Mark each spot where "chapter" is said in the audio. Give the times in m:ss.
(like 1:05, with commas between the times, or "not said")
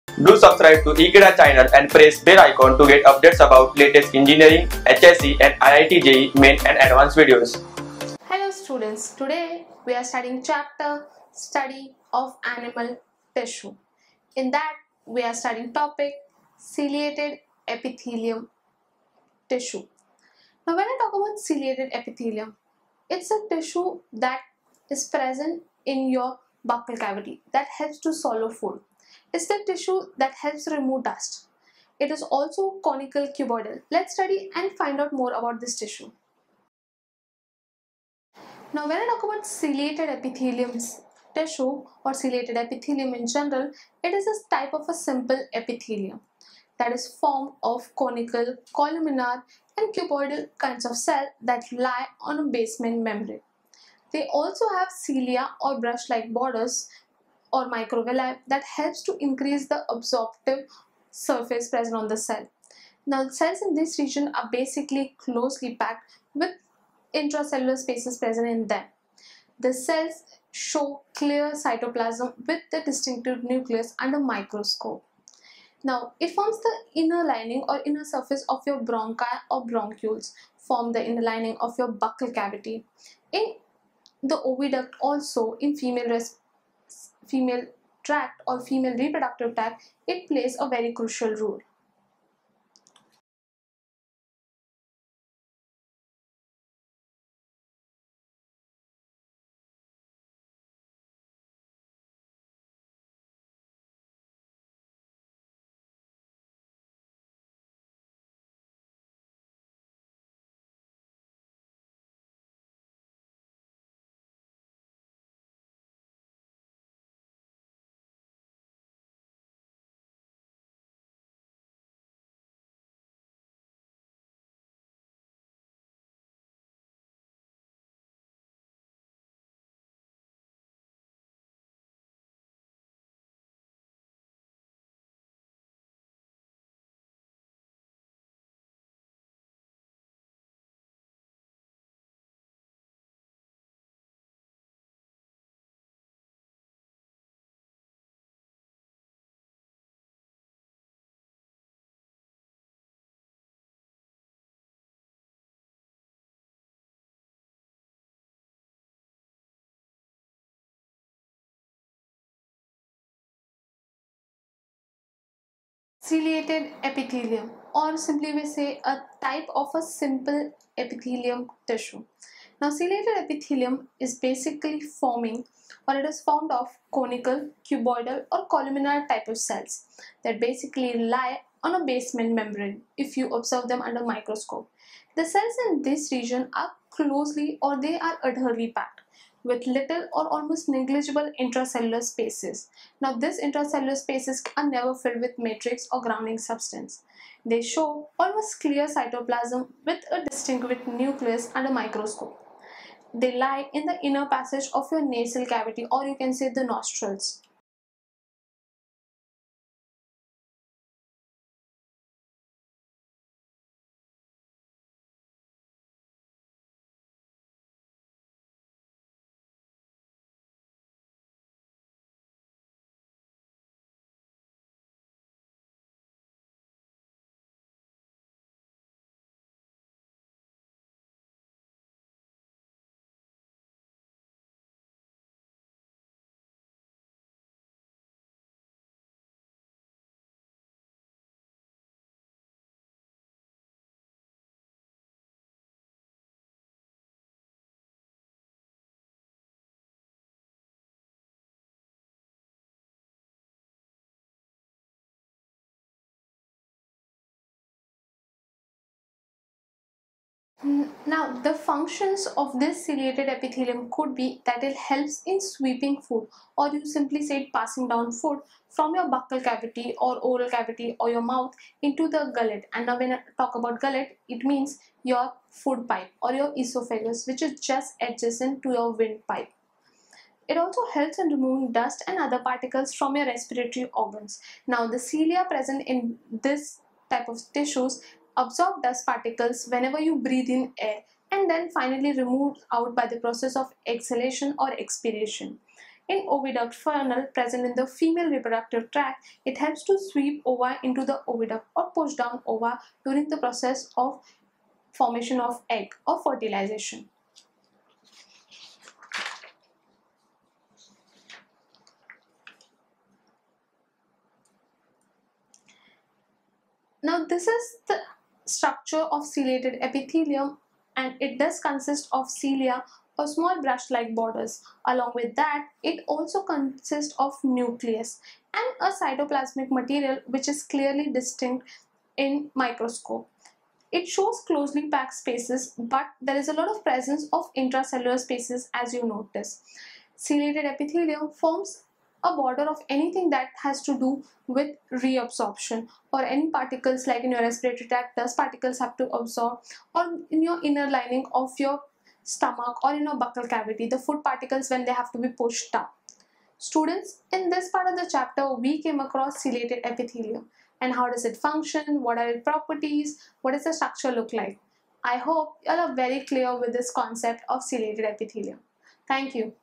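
0:10, 5:58.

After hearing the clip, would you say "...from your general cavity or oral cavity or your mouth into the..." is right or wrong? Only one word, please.
wrong.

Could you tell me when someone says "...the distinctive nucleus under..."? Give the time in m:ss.
1:12.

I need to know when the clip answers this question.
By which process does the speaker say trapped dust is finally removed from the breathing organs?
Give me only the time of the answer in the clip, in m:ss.
4:54.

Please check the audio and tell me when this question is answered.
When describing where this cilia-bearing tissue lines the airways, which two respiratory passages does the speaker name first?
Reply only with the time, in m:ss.
1:18.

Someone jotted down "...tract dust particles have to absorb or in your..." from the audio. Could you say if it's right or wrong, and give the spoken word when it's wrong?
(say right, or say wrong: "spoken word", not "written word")
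right.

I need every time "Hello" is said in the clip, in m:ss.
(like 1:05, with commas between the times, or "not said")
0:08.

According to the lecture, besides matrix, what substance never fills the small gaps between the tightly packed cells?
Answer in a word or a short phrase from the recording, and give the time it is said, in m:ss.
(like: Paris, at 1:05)
grounding substance, at 3:16.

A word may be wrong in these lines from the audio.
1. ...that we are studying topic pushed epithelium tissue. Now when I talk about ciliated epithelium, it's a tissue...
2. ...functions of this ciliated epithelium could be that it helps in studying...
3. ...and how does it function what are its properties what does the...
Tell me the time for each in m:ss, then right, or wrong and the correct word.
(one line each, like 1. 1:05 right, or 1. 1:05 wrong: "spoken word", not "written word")
1. 0:14 wrong: "ciliated", not "pushed"
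2. 4:21 wrong: "sweeping", not "studying"
3. 6:00 right.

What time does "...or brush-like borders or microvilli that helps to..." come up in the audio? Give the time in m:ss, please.
0:55.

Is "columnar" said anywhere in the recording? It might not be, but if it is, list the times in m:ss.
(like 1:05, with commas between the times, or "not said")
0:48, 2:58.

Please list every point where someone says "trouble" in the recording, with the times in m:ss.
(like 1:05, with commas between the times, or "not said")
not said.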